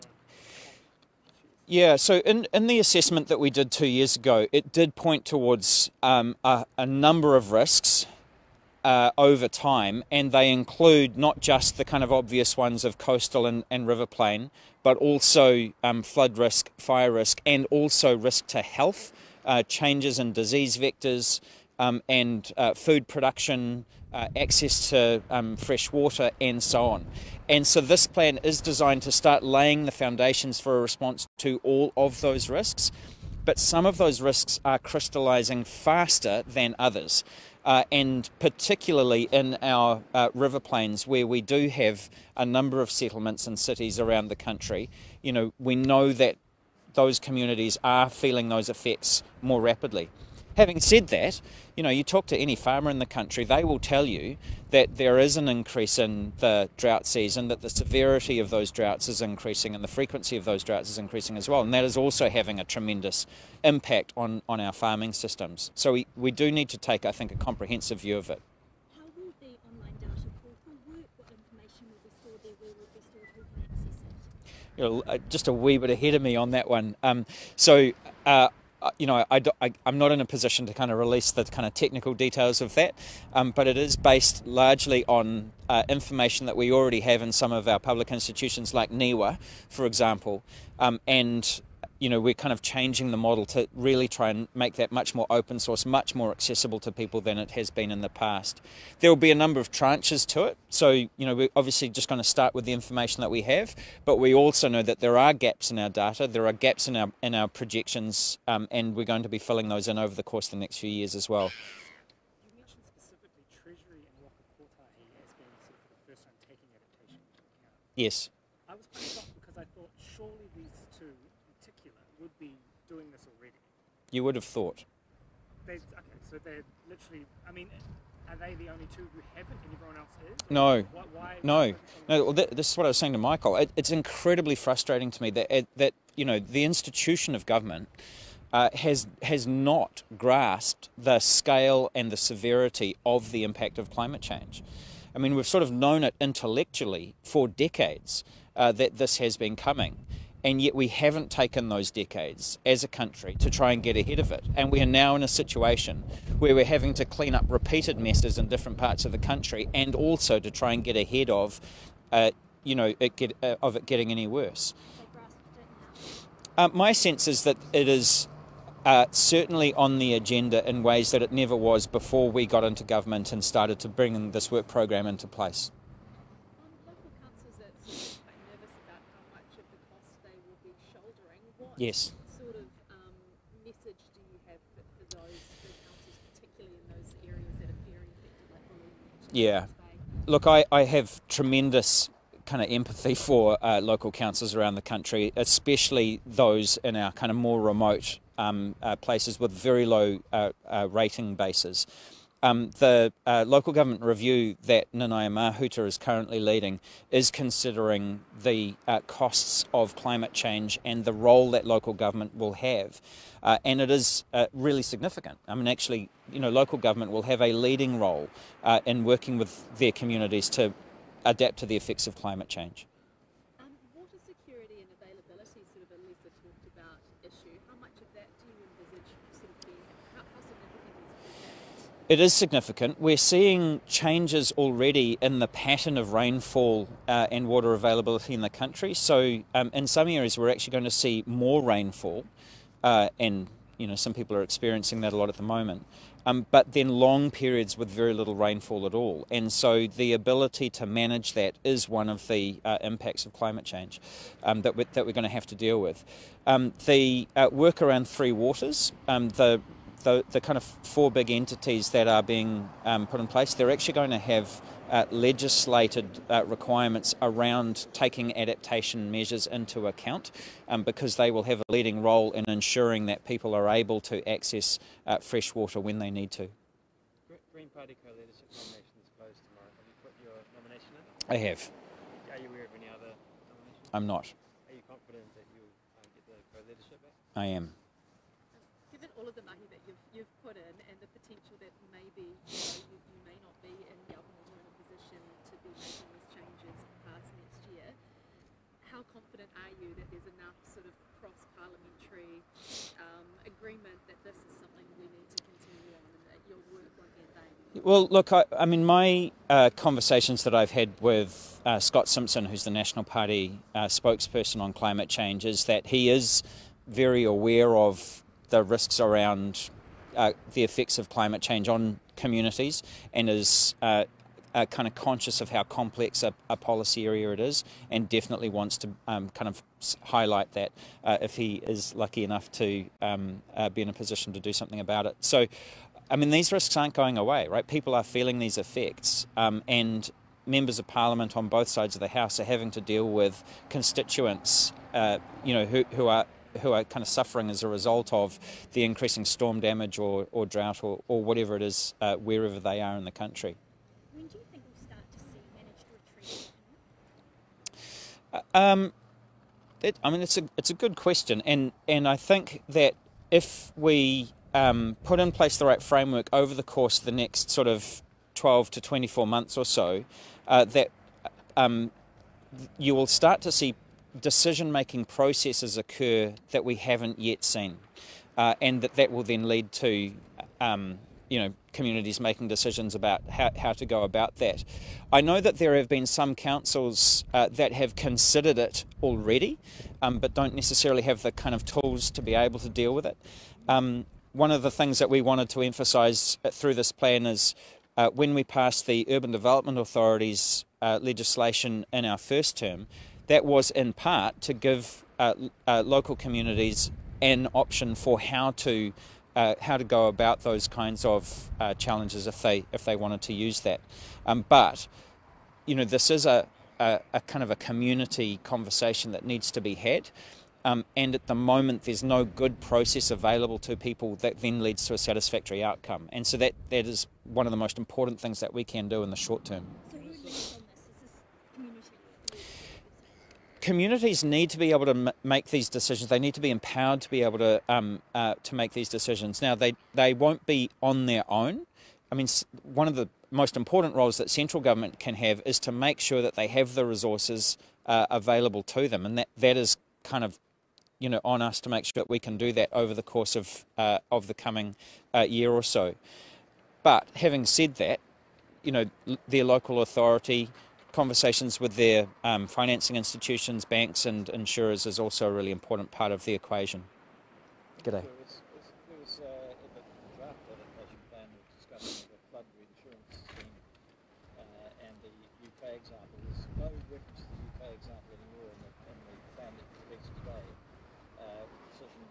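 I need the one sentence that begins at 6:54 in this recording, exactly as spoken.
Um, but you know, this is a, a, a kind of a community conversation that needs to be had.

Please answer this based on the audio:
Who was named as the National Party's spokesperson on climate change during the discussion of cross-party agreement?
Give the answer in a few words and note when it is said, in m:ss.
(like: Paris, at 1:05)
Scott Simpson, at 5:11.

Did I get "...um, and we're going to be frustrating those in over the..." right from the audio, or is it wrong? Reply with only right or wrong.
wrong.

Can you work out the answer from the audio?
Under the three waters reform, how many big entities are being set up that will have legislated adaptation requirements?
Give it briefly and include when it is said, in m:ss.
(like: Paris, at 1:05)
4, at 4:20.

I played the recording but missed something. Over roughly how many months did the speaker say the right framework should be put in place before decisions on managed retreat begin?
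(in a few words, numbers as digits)
12 to 24 months.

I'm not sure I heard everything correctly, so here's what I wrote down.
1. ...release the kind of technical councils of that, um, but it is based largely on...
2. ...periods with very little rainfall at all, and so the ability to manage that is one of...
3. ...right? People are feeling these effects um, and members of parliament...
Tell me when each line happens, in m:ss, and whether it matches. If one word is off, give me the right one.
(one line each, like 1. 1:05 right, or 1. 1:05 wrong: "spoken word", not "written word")
1. 1:20 wrong: "details", not "councils"
2. 4:07 right
3. 5:37 right.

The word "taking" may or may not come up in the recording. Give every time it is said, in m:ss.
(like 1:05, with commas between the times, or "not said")
4:27.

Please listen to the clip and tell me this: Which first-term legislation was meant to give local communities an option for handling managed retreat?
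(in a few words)
Urban Development Authorities.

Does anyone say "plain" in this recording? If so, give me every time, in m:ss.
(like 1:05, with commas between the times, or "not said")
0:14, 0:40.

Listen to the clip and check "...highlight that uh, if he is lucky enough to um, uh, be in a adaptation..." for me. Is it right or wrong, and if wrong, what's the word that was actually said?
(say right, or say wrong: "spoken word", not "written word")
wrong: "position", not "adaptation".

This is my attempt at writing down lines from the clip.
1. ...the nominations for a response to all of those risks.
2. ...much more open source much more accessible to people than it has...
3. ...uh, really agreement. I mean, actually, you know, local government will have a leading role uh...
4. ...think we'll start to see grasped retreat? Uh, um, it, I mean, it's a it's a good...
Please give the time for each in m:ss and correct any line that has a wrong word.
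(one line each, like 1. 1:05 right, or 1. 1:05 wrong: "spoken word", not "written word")
1. 0:29 wrong: "foundations", not "nominations"
2. 1:34 right
3. 3:34 wrong: "significant", not "agreement"
4. 5:54 wrong: "managed", not "grasped".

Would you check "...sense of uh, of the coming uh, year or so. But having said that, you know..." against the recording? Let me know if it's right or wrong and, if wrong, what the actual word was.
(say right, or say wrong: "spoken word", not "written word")
wrong: "course", not "sense".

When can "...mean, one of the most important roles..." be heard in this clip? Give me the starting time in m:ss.
7:22.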